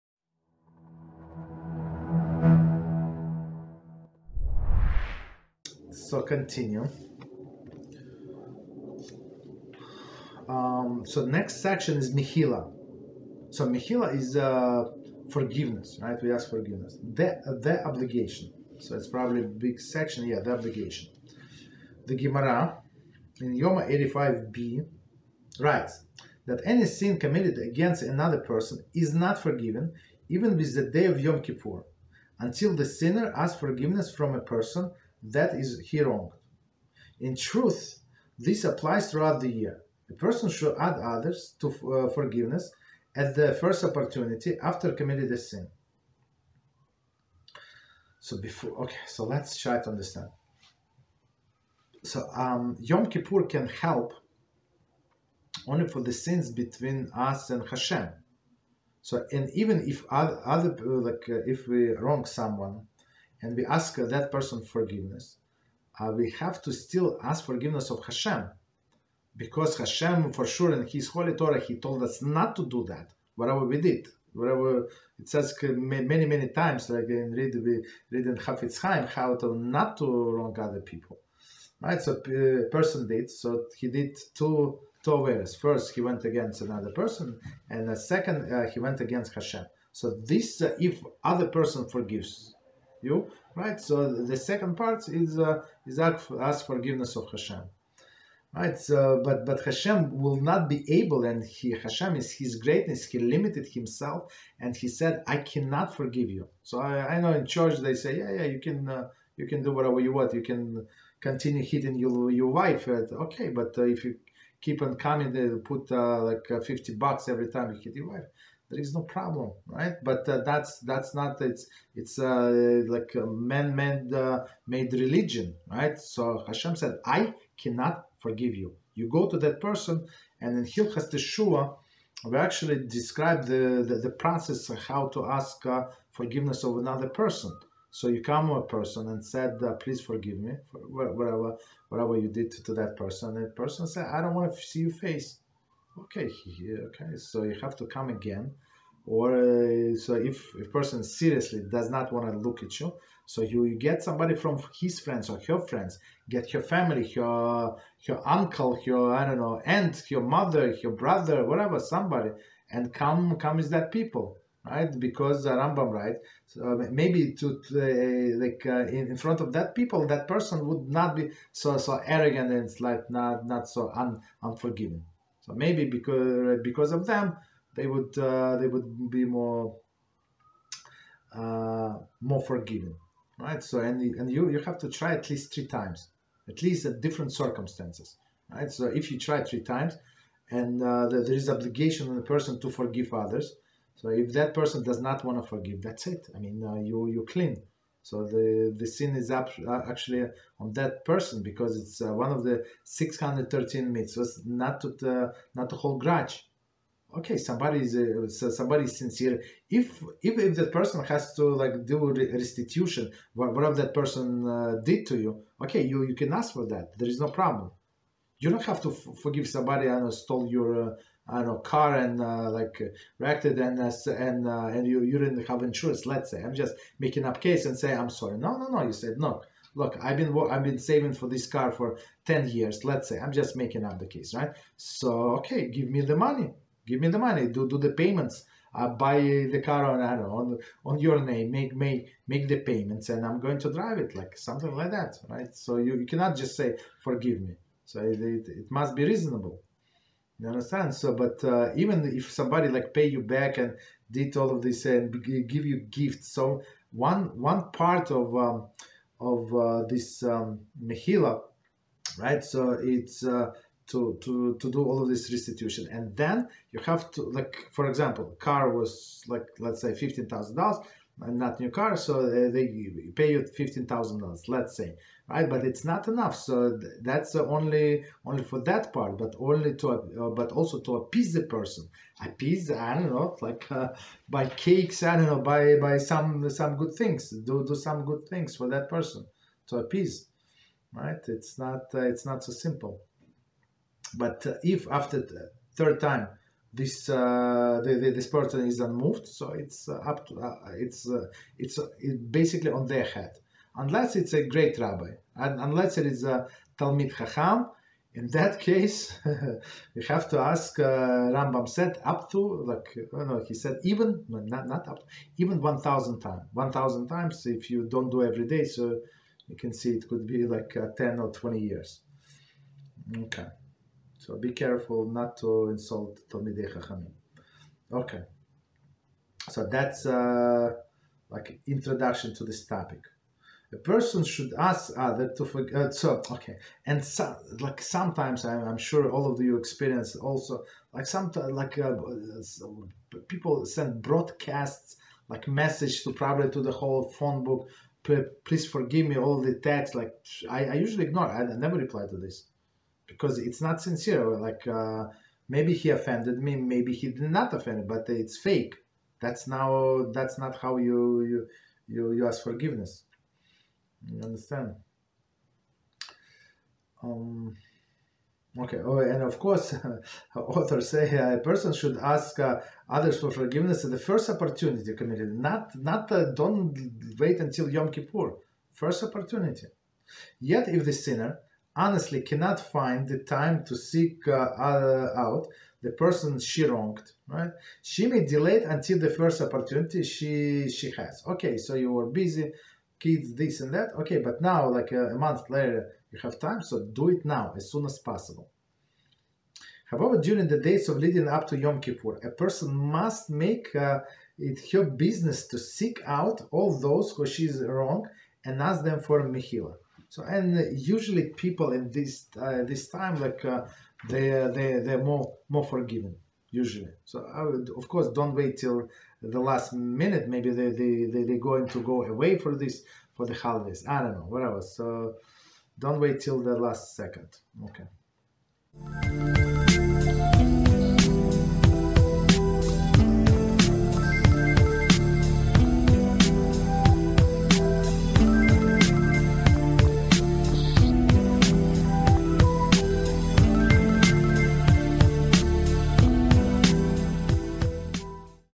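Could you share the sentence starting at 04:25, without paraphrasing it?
And then you have to, like, for example, car was like, let's say $15,000 and not new car.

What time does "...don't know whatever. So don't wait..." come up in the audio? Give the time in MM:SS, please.
07:04.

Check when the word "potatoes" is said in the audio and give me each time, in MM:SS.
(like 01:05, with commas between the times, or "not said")
not said.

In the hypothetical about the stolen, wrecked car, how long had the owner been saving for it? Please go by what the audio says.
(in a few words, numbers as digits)
10 years.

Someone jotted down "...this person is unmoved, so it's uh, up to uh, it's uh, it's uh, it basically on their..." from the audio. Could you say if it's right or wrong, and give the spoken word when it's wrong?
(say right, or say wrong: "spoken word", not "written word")
right.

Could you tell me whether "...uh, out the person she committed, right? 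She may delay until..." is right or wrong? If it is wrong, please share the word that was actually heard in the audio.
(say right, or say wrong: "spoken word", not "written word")
wrong: "wronged", not "committed".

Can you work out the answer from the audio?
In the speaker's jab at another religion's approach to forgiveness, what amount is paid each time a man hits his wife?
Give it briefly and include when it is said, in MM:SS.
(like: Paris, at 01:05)
$50, at 01:56.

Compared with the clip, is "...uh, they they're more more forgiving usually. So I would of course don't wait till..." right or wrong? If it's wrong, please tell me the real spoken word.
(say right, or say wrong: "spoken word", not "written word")
right.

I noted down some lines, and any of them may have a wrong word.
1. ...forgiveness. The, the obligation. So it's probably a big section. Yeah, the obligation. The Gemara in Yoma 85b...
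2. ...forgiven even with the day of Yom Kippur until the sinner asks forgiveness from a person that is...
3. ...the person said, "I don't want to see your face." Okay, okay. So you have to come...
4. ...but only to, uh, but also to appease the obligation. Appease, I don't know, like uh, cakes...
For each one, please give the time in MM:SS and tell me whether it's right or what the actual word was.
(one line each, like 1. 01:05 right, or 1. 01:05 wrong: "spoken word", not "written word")
1. 00:16 right
2. 00:29 right
3. 02:23 right
4. 04:39 wrong: "person", not "obligation".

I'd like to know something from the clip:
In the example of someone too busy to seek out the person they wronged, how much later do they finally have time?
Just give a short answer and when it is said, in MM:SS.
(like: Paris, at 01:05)
A month, at 06:35.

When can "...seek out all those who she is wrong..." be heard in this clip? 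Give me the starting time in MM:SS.
06:45.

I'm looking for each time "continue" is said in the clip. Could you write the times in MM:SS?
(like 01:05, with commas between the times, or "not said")
00:06, 01:51.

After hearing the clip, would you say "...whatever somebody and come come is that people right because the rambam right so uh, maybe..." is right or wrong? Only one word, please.
right.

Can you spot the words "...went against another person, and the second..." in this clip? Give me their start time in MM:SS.
01:25.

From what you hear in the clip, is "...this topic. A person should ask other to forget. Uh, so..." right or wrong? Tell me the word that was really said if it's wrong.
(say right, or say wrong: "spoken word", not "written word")
right.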